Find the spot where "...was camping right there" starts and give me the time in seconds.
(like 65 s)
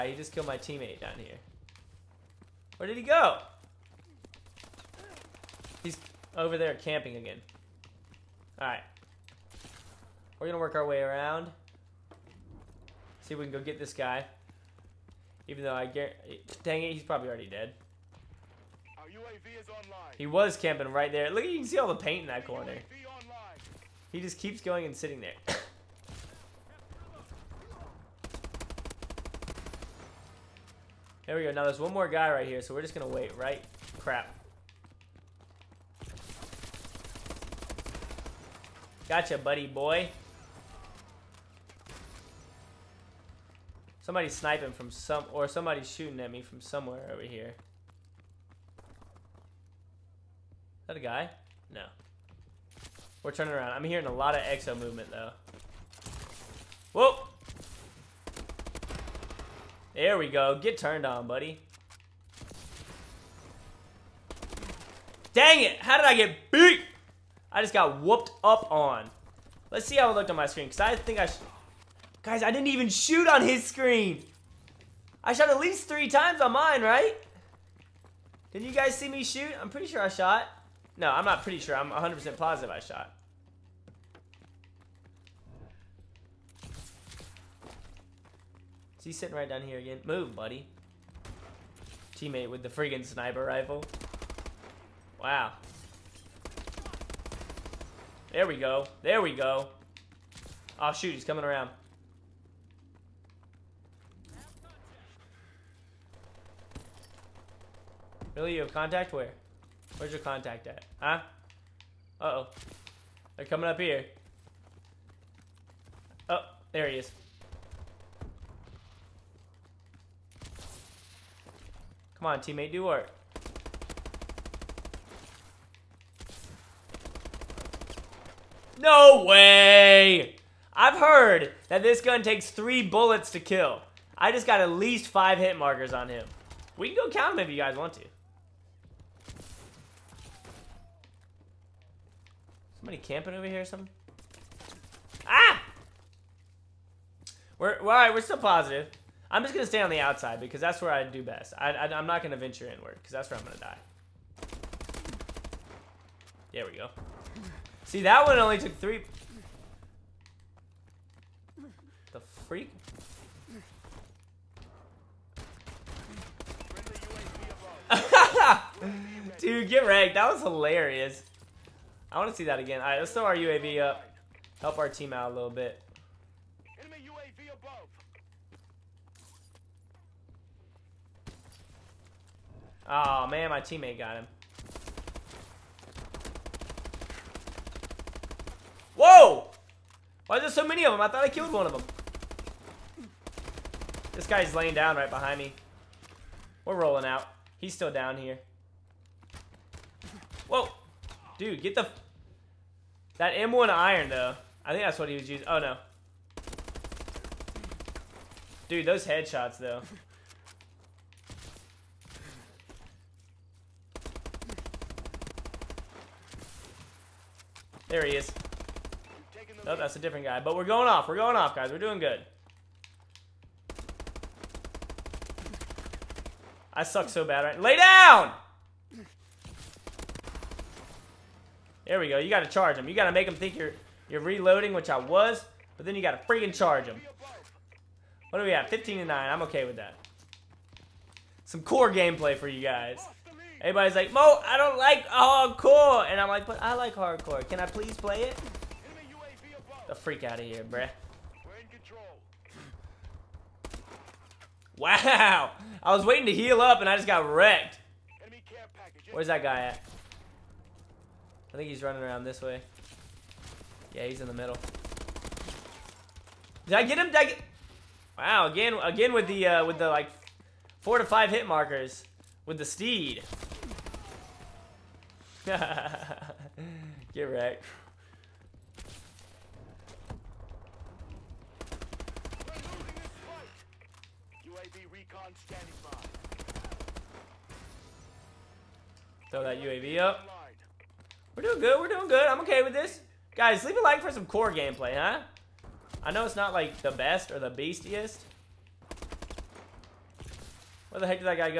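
20 s.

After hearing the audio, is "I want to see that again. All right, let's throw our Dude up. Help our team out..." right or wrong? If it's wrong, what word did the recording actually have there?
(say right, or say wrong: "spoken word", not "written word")
wrong: "UAV", not "Dude".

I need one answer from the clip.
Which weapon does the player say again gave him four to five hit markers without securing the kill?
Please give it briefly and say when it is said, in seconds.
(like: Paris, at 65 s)
the steed, at 272 s.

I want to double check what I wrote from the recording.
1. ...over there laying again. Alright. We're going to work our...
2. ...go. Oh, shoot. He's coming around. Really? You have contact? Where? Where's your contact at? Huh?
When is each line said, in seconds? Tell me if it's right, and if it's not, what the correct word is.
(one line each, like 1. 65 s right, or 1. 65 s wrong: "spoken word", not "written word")
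1. 6 s wrong: "camping", not "laying"
2. 99 s right.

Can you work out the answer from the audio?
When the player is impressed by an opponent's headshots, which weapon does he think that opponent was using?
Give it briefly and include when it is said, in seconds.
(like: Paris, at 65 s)
M1 iron, at 203 s.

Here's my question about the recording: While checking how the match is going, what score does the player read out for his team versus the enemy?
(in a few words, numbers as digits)
15 to 9.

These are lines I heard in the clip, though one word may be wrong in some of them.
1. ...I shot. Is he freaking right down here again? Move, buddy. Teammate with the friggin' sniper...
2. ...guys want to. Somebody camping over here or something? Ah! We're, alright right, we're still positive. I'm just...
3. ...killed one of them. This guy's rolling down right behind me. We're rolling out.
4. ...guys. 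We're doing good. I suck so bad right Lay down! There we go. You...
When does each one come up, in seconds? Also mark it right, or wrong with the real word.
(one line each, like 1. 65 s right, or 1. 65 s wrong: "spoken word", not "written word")
1. 82 s wrong: "sitting", not "freaking"
2. 137 s right
3. 191 s wrong: "laying", not "rolling"
4. 221 s right.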